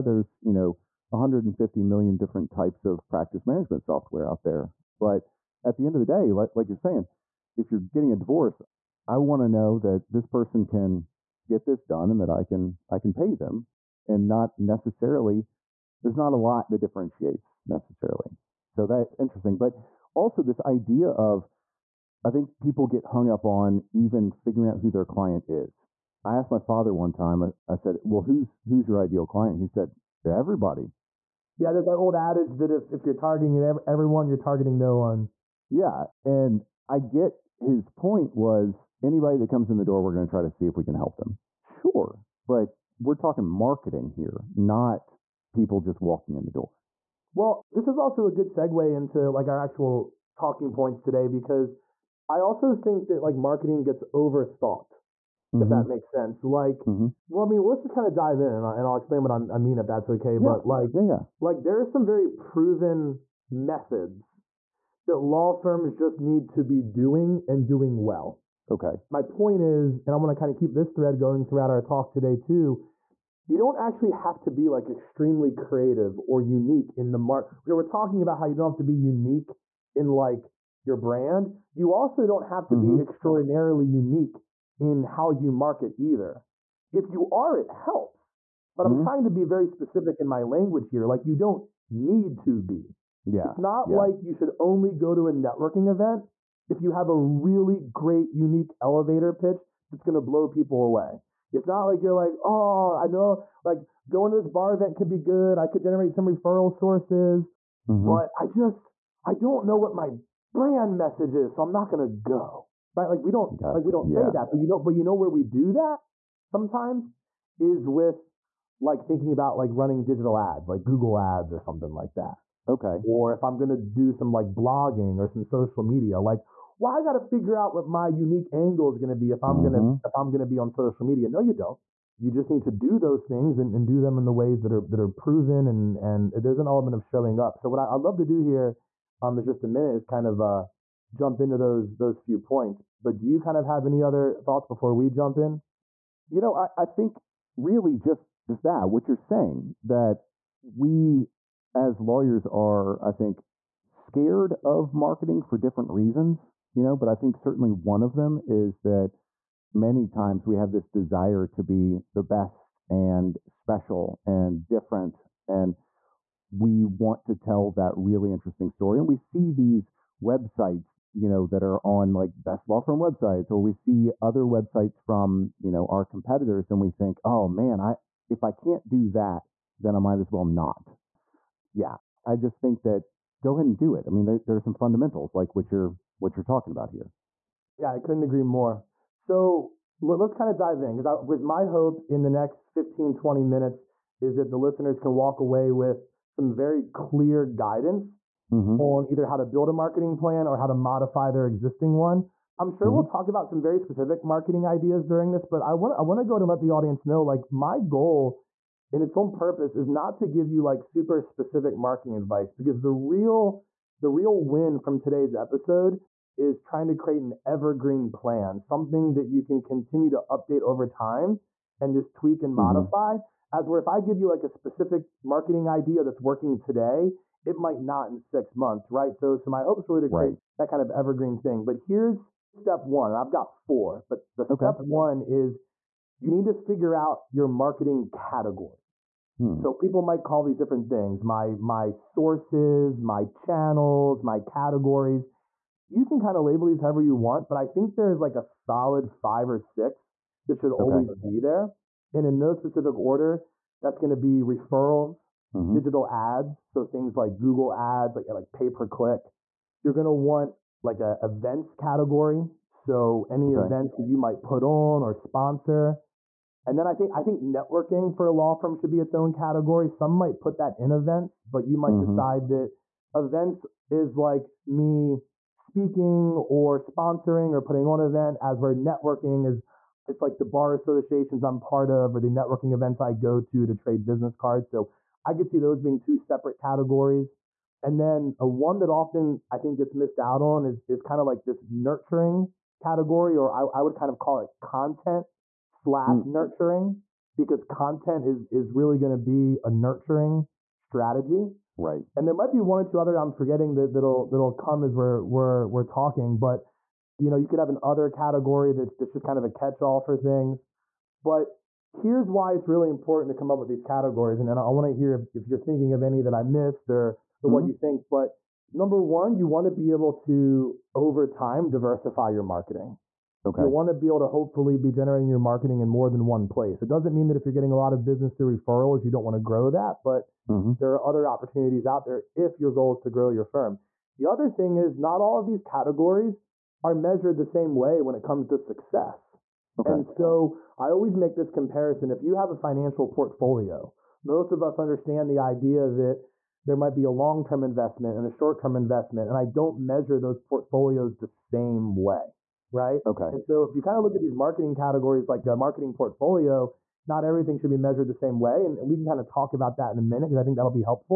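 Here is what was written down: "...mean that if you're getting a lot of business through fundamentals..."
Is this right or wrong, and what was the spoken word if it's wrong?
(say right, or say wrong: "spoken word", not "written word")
wrong: "referrals", not "fundamentals".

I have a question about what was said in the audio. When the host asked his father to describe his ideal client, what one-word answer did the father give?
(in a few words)
Everybody.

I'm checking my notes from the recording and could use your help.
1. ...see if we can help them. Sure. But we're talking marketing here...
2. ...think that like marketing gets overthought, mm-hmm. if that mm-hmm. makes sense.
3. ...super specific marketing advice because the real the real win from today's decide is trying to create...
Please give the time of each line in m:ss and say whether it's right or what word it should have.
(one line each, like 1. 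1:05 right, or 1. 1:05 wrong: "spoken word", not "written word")
1. 0:40 right
2. 0:52 right
3. 3:30 wrong: "episode", not "decide".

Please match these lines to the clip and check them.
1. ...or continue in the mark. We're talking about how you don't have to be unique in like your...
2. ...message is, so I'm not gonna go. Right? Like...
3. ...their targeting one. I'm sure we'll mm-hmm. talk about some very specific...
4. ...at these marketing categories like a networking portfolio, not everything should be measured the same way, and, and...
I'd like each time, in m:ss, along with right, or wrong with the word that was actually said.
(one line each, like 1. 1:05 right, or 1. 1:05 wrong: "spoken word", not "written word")
1. 1:16 wrong: "unique", not "continue"
2. 1:50 right
3. 3:21 wrong: "existing", not "targeting"
4. 5:54 wrong: "marketing", not "networking".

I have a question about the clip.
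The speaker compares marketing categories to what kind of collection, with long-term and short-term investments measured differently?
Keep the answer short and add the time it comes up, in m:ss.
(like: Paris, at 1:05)
Financial portfolio, at 5:42.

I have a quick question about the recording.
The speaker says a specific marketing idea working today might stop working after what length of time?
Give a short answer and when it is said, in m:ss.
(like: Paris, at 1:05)
6 months, at 3:48.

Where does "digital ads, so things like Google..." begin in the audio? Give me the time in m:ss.
4:15.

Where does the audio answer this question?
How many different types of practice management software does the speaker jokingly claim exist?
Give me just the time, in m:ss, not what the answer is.
0:01.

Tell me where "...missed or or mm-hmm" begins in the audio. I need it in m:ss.
5:16.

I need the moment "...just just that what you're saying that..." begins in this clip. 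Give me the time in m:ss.
2:27.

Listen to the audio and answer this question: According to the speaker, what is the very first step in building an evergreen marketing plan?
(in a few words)
Figure out your marketing category.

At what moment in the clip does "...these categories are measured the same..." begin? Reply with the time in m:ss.
5:35.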